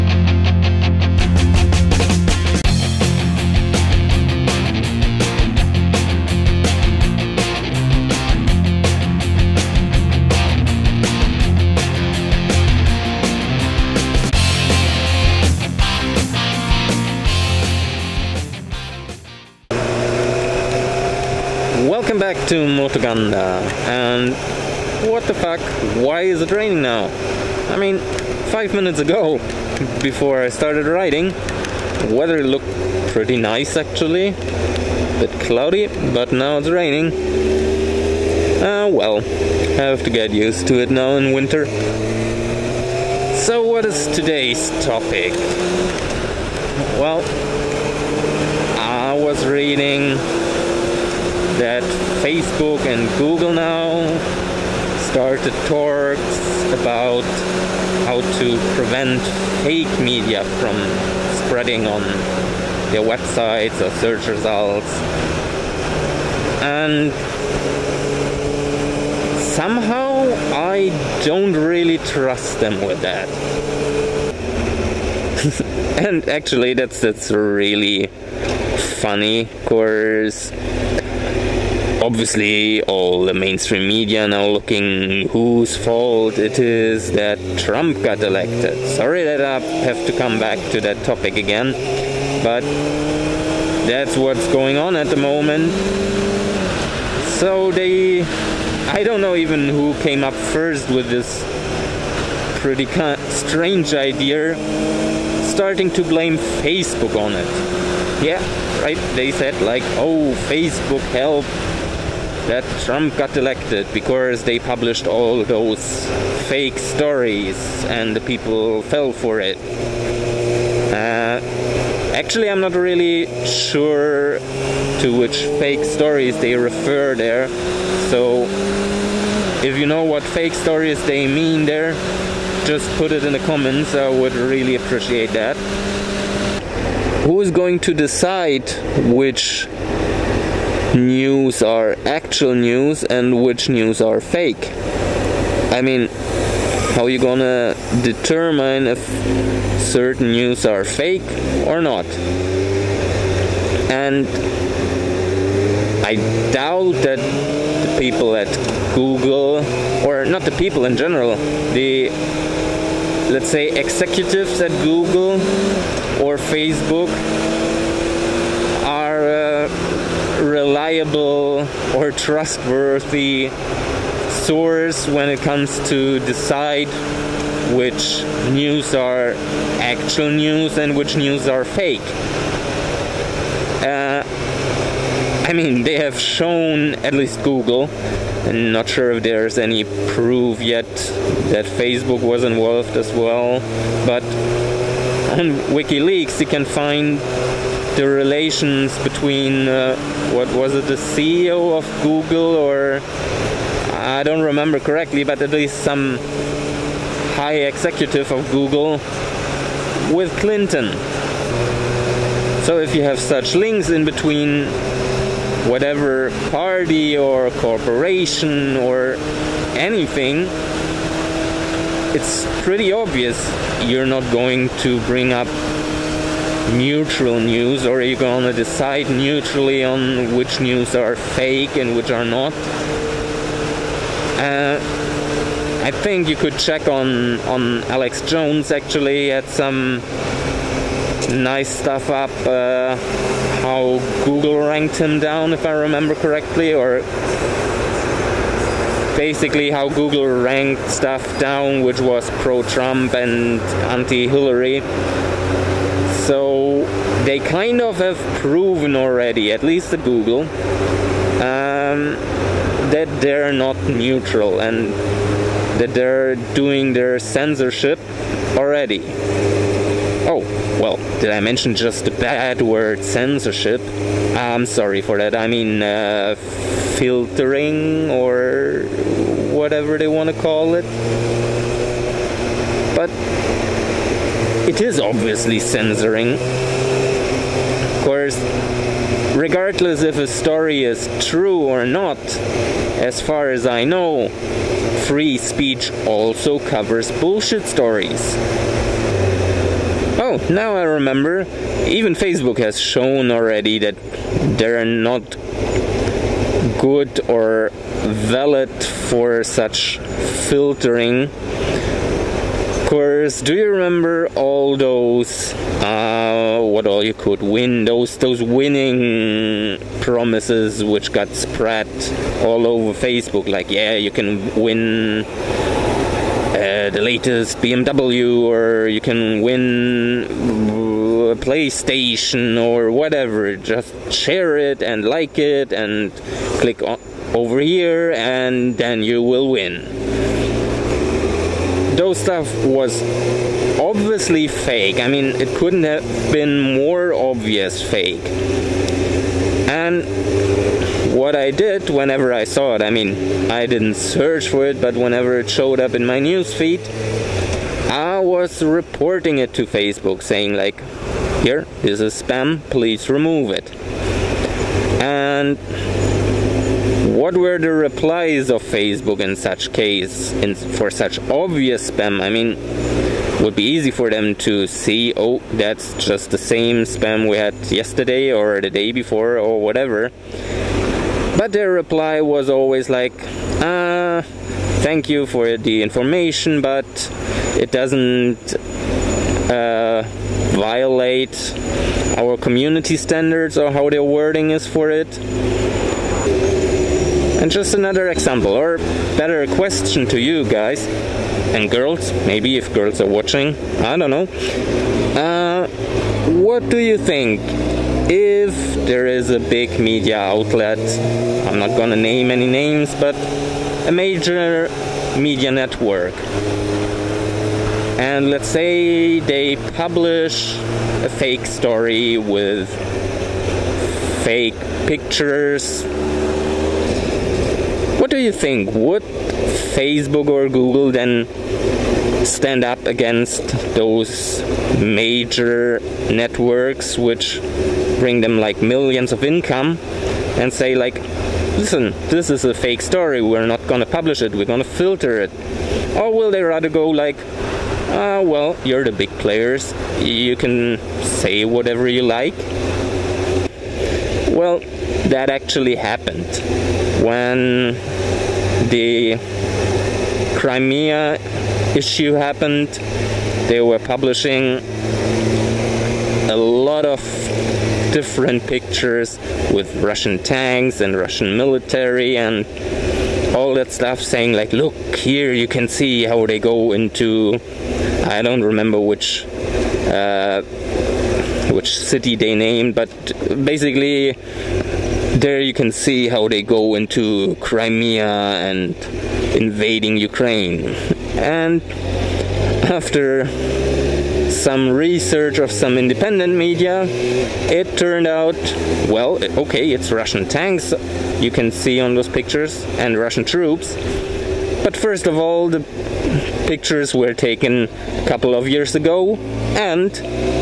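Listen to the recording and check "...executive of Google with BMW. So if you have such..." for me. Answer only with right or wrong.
wrong.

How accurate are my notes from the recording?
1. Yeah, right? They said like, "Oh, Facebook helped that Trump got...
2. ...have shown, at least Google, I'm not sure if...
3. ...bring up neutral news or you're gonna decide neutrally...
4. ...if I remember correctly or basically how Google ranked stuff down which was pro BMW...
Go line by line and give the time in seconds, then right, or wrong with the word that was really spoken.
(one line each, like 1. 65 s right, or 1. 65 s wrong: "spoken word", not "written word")
1. 108 s right
2. 185 s right
3. 225 s right
4. 245 s wrong: "Trump", not "BMW".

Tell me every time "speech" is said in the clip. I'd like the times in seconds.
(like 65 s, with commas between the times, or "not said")
295 s.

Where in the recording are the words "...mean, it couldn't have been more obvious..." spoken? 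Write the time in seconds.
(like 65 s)
345 s.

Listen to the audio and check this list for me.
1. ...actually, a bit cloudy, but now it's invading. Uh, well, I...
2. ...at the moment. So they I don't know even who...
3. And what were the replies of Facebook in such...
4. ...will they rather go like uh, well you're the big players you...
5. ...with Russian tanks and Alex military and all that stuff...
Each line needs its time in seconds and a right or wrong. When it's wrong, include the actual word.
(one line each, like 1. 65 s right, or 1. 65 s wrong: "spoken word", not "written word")
1. 33 s wrong: "raining", not "invading"
2. 94 s right
3. 365 s right
4. 446 s right
5. 469 s wrong: "Russian", not "Alex".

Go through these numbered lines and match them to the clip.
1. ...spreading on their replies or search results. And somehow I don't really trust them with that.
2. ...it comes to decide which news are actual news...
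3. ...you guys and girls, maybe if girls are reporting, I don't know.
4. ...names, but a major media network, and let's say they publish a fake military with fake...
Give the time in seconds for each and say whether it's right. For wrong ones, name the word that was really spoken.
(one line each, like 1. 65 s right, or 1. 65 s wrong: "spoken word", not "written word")
1. 61 s wrong: "websites", not "replies"
2. 175 s right
3. 400 s wrong: "watching", not "reporting"
4. 412 s wrong: "story", not "military".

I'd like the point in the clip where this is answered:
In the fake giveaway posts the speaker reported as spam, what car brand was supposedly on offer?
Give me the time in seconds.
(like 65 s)
327 s.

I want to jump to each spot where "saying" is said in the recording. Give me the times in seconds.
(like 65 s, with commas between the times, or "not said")
360 s, 473 s.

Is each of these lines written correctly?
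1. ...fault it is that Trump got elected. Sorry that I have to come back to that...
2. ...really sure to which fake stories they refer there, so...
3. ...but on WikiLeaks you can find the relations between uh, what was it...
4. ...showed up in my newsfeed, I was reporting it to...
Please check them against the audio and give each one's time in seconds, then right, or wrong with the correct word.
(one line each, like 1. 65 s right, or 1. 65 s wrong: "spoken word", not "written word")
1. 85 s right
2. 122 s right
3. 194 s right
4. 355 s right.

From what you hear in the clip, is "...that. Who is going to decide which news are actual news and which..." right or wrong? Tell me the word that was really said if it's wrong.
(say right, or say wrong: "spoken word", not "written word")
right.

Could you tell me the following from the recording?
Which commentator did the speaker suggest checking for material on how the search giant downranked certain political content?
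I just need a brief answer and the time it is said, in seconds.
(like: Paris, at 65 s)
Alex Jones, at 237 s.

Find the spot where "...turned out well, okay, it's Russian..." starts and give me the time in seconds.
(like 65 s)
497 s.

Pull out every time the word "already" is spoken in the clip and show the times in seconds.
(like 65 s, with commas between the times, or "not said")
258 s, 268 s, 303 s.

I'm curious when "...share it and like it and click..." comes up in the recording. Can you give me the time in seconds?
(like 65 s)
334 s.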